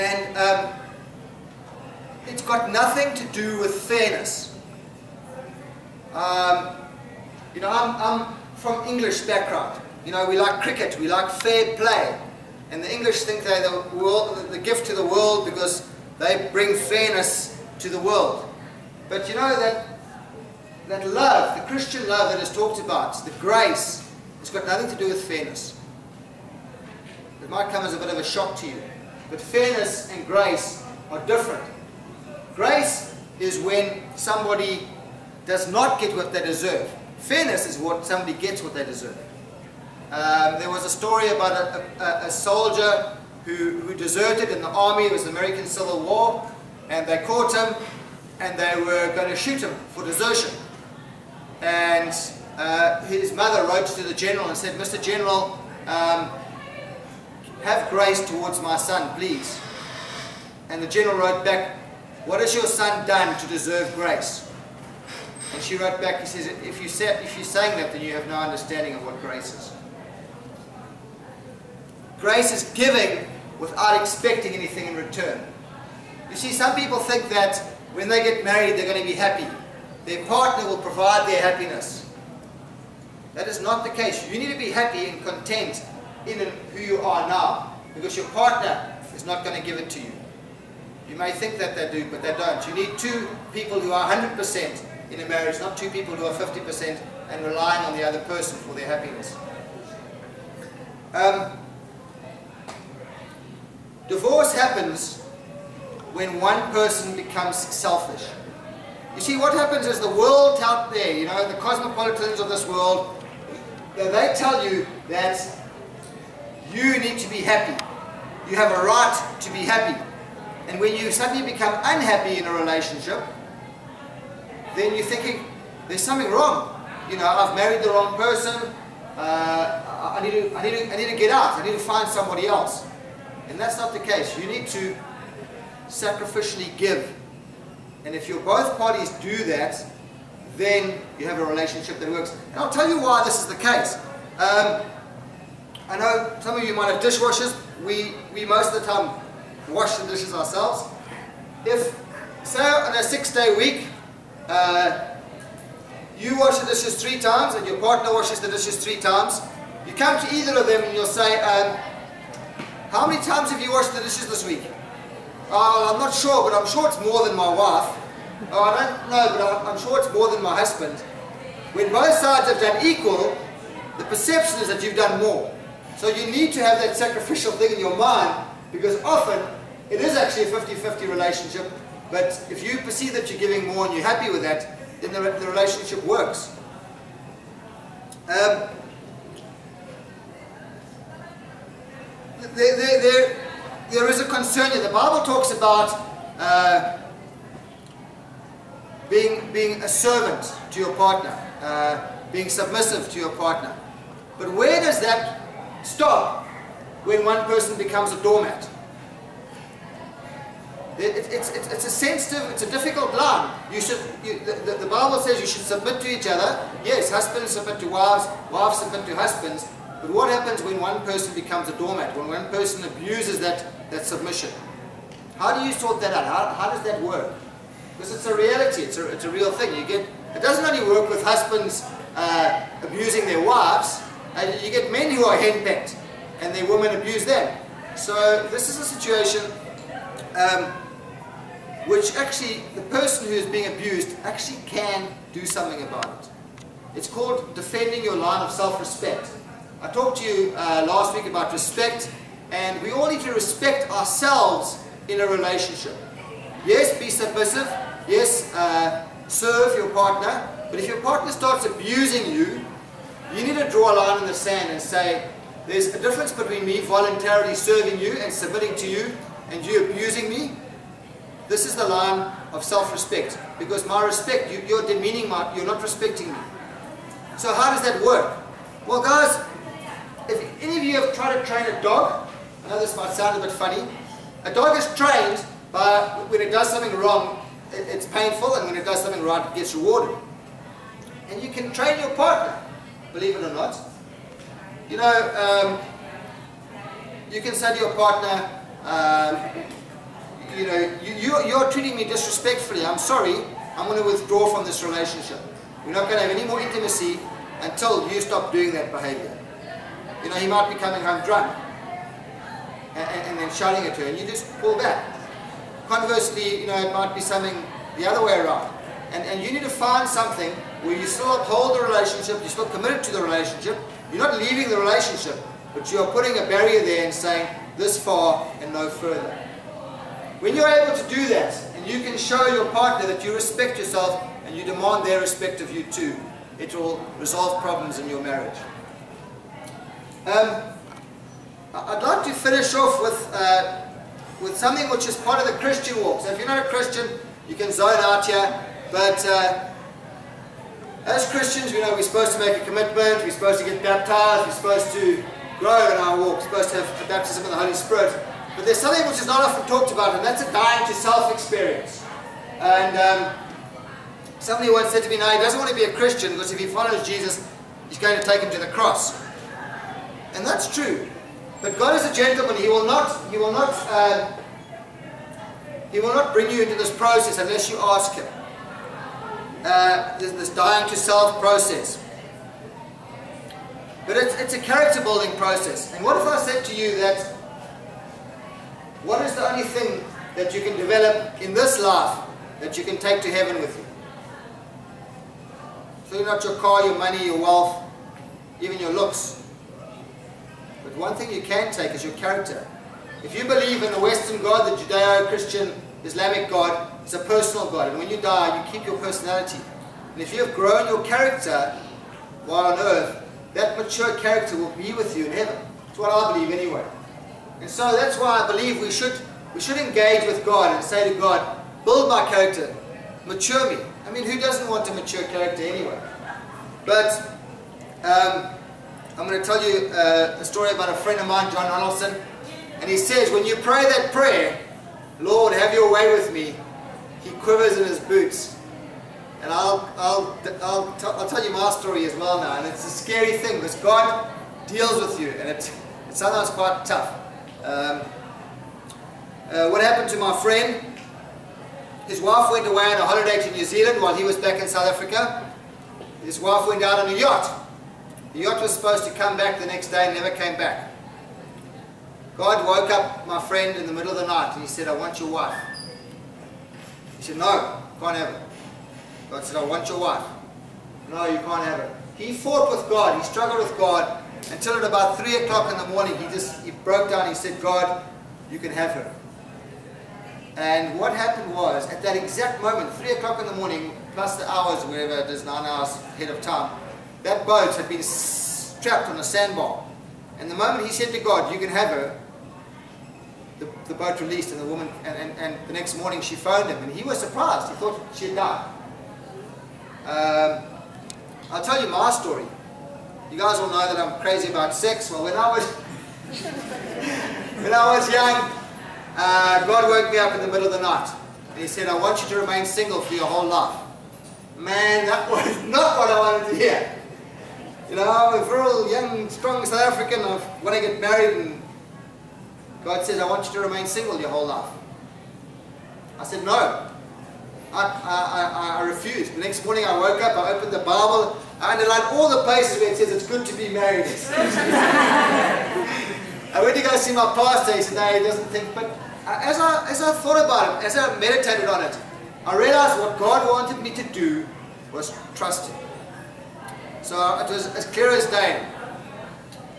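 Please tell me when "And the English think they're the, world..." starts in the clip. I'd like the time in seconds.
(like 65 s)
12 s.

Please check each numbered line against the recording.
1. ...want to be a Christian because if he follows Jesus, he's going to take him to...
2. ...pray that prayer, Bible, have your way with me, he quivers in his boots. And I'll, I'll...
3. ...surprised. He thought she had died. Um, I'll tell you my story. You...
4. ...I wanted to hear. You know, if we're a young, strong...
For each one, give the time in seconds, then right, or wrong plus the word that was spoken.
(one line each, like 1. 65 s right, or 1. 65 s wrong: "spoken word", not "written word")
1. 365 s right
2. 433 s wrong: "Lord", not "Bible"
3. 497 s right
4. 516 s right.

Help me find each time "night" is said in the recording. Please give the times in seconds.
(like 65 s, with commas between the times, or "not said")
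464 s, 510 s.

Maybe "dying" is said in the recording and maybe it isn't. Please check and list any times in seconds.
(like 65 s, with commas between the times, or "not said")
360 s, 380 s.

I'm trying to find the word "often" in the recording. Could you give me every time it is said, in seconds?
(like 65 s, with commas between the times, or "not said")
179 s, 359 s.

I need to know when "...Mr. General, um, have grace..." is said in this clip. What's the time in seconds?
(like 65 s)
54 s.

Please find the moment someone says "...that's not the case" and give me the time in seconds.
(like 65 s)
133 s.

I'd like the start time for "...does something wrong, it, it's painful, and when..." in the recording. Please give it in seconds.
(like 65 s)
286 s.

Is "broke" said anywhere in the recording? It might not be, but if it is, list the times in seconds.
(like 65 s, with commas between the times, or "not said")
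476 s.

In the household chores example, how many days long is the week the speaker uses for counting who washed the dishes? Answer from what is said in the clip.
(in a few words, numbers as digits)
6.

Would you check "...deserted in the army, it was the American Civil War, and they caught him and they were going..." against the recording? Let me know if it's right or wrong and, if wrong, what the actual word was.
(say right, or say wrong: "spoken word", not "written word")
right.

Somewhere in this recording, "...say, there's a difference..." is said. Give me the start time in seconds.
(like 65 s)
264 s.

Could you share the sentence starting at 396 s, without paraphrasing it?
So not your car, your money, your wealth, even your looks.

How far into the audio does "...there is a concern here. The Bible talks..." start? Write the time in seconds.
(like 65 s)
193 s.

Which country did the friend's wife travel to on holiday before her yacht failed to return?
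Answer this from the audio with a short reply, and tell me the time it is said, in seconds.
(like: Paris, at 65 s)
New Zealand, at 453 s.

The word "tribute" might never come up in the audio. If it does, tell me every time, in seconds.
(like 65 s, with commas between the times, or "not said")
not said.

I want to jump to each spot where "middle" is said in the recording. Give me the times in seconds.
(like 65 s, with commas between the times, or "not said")
463 s, 510 s.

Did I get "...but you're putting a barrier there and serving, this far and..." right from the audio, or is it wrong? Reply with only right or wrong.
wrong.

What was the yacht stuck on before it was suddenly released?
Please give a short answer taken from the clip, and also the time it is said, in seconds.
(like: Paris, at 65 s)
a sandbar, at 489 s.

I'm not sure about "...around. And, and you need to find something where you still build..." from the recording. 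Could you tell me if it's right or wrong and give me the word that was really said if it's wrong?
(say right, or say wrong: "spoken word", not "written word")
wrong: "uphold", not "build".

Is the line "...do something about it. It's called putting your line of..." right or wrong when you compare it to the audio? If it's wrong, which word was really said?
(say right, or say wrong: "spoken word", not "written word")
wrong: "defending", not "putting".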